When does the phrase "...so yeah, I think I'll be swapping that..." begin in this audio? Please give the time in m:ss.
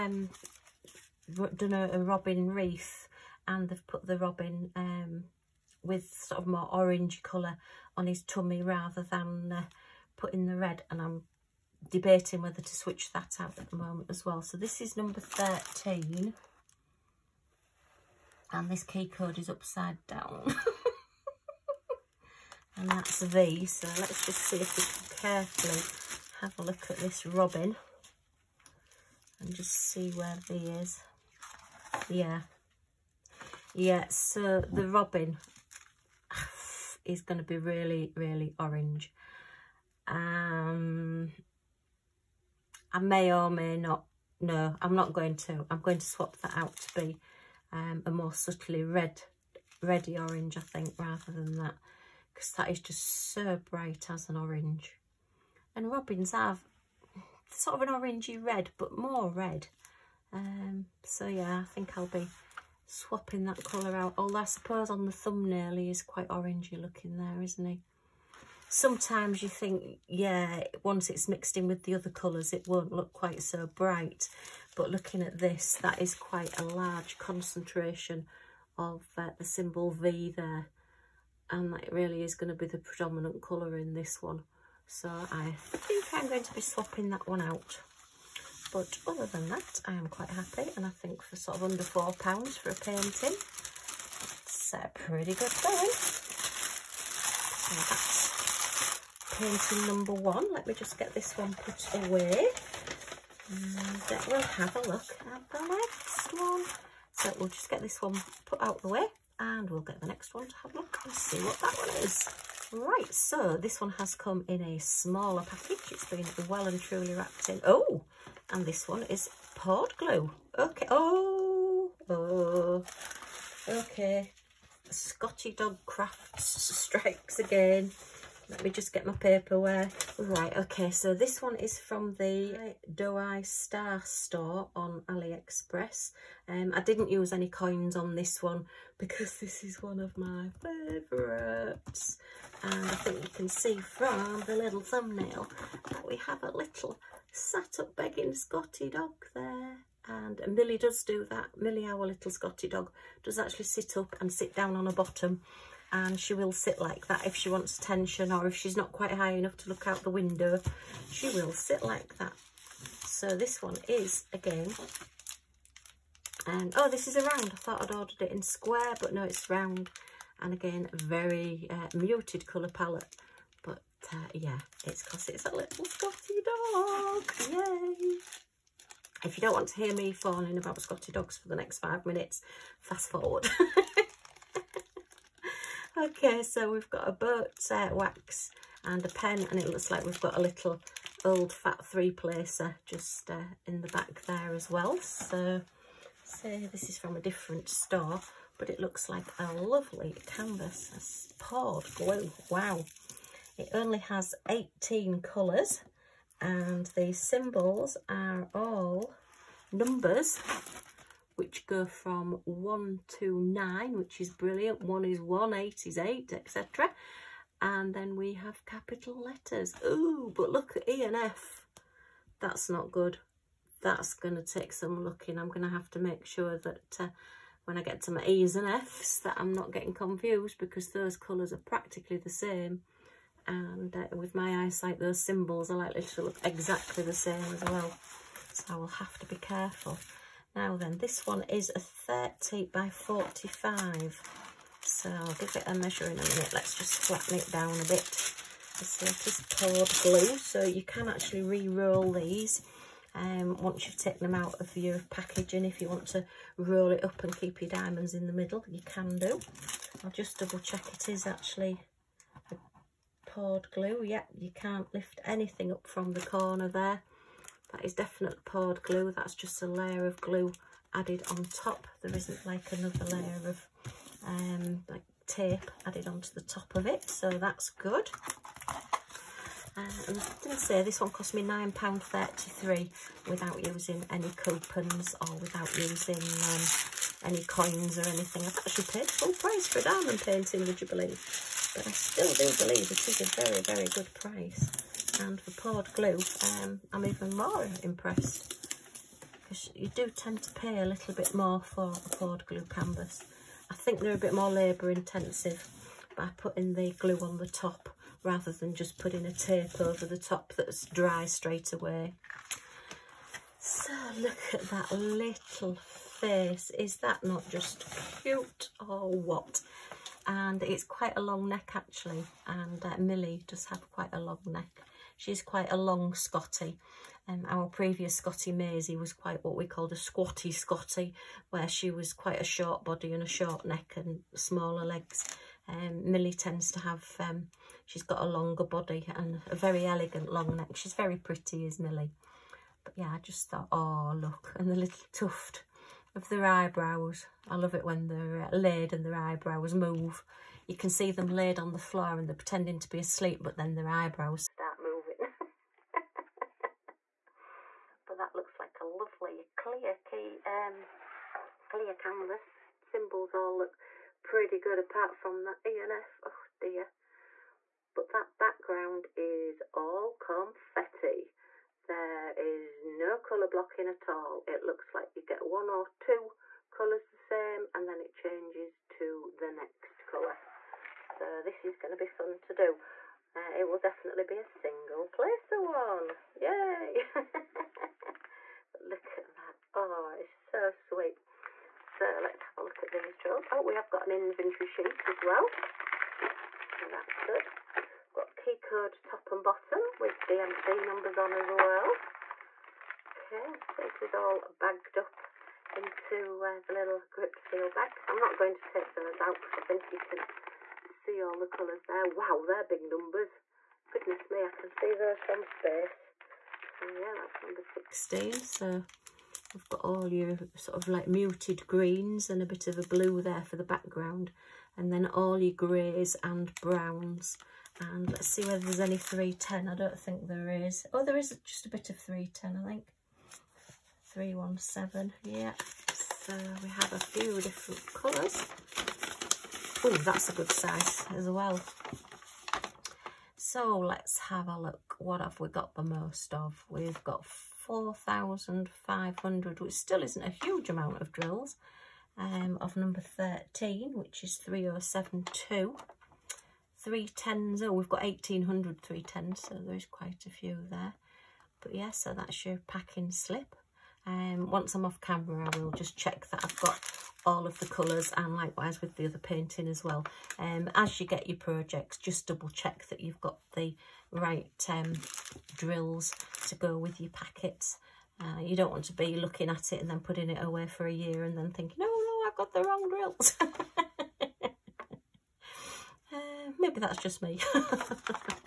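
1:01.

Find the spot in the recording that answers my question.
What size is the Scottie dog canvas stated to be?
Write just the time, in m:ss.
4:01.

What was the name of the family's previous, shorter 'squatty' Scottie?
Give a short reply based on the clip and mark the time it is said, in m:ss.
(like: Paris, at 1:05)
Maisie, at 5:28.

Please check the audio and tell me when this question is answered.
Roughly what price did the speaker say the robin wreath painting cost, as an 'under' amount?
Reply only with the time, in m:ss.
1:31.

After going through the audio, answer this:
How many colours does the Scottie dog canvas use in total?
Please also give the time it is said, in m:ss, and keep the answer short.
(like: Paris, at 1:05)
18, at 3:24.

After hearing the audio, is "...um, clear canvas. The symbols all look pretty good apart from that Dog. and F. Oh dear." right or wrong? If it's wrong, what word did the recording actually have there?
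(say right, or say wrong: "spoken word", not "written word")
wrong: "ENF", not "Dog".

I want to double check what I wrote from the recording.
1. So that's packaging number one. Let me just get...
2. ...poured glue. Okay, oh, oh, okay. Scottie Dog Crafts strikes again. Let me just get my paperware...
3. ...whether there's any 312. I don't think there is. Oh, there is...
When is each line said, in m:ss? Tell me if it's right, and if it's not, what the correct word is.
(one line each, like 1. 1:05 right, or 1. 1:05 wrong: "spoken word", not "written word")
1. 1:37 wrong: "painting", not "packaging"
2. 1:59 right
3. 7:08 wrong: "310", not "312".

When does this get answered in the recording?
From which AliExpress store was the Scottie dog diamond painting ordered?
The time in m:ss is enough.
2:12.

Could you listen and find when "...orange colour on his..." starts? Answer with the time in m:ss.
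0:06.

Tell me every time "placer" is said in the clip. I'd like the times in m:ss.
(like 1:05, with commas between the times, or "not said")
3:12, 6:25.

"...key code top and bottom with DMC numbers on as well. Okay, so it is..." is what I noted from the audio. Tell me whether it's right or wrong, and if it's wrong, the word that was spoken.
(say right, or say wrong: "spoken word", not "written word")
right.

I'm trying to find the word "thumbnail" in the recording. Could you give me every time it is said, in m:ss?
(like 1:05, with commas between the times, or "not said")
1:05, 2:24.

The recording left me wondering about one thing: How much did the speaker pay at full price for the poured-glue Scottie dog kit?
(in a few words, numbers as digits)
£9.33.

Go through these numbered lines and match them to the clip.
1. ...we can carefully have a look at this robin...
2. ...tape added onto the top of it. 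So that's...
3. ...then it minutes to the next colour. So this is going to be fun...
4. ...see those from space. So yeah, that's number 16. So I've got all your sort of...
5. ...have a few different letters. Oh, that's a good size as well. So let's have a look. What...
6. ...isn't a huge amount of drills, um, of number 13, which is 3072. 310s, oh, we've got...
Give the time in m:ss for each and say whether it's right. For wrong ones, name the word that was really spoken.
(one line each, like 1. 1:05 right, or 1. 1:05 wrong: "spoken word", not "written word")
1. 0:24 right
2. 4:35 right
3. 6:17 wrong: "changes", not "minutes"
4. 6:54 right
5. 7:16 wrong: "colours", not "letters"
6. 7:30 right.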